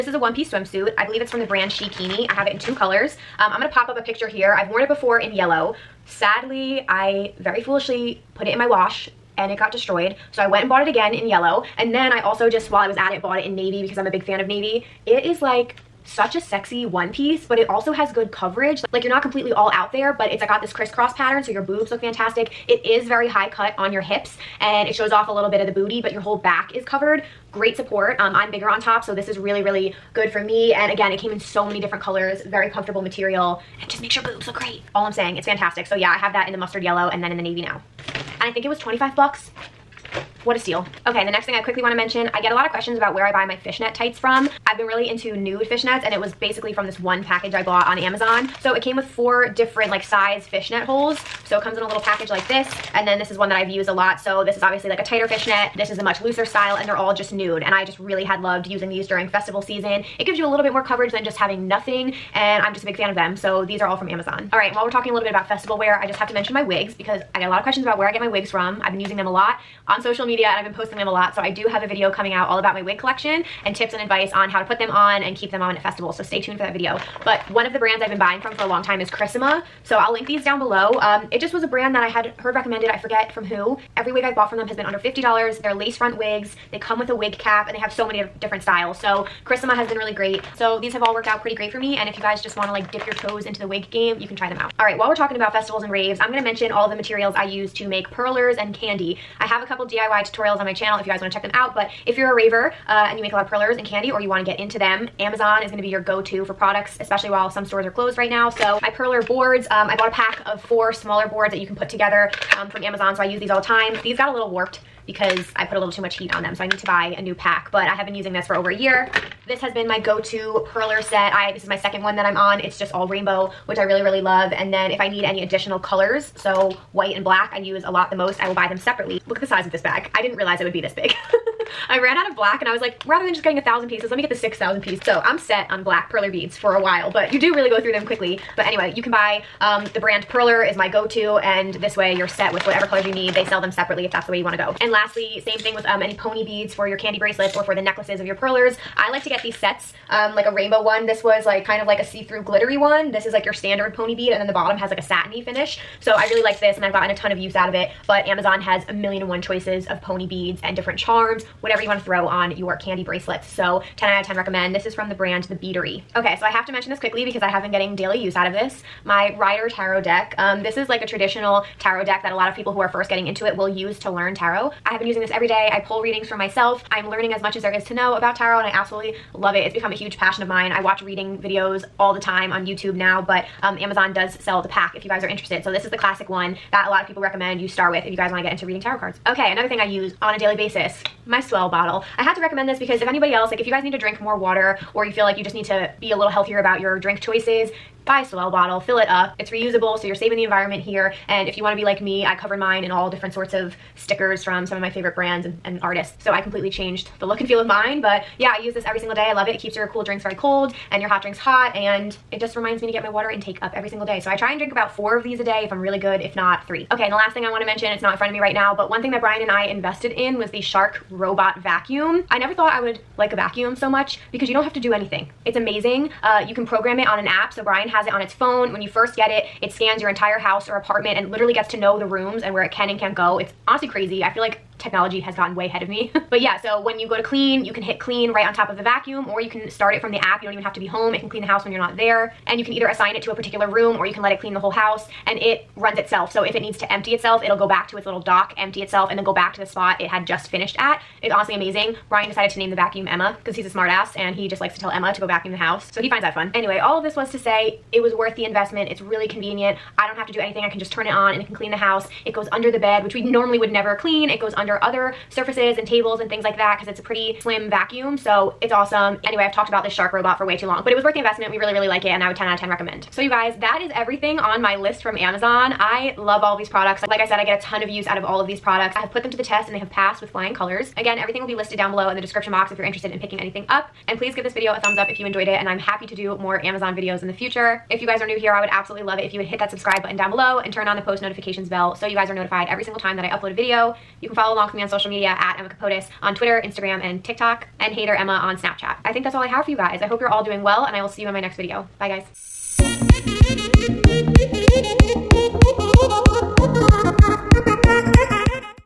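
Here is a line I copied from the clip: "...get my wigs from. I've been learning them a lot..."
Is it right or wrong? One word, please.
wrong.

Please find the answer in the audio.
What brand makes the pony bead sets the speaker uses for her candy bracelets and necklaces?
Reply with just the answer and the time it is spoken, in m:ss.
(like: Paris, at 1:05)
The Beadery, at 2:45.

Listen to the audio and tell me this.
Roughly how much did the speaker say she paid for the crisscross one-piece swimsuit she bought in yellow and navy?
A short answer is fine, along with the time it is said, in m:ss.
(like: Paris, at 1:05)
$25, at 0:38.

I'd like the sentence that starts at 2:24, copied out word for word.
And lastly, same thing with um, any pony beads for your candy bracelets or for the necklaces of your perlers.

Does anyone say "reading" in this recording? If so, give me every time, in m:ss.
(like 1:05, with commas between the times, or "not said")
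2:56, 3:01, 3:08.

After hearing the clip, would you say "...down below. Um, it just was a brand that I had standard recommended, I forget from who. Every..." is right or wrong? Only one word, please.
wrong.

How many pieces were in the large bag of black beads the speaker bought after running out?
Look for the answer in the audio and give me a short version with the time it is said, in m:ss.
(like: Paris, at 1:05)
6,000, at 2:14.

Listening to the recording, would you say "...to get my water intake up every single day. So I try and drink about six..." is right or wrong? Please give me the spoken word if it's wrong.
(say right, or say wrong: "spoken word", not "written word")
wrong: "four", not "six".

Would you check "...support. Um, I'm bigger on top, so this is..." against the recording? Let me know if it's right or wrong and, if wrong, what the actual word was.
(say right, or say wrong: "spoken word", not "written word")
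right.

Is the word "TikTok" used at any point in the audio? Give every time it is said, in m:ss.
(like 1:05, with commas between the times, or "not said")
4:57.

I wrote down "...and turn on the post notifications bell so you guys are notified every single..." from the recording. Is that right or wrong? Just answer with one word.
right.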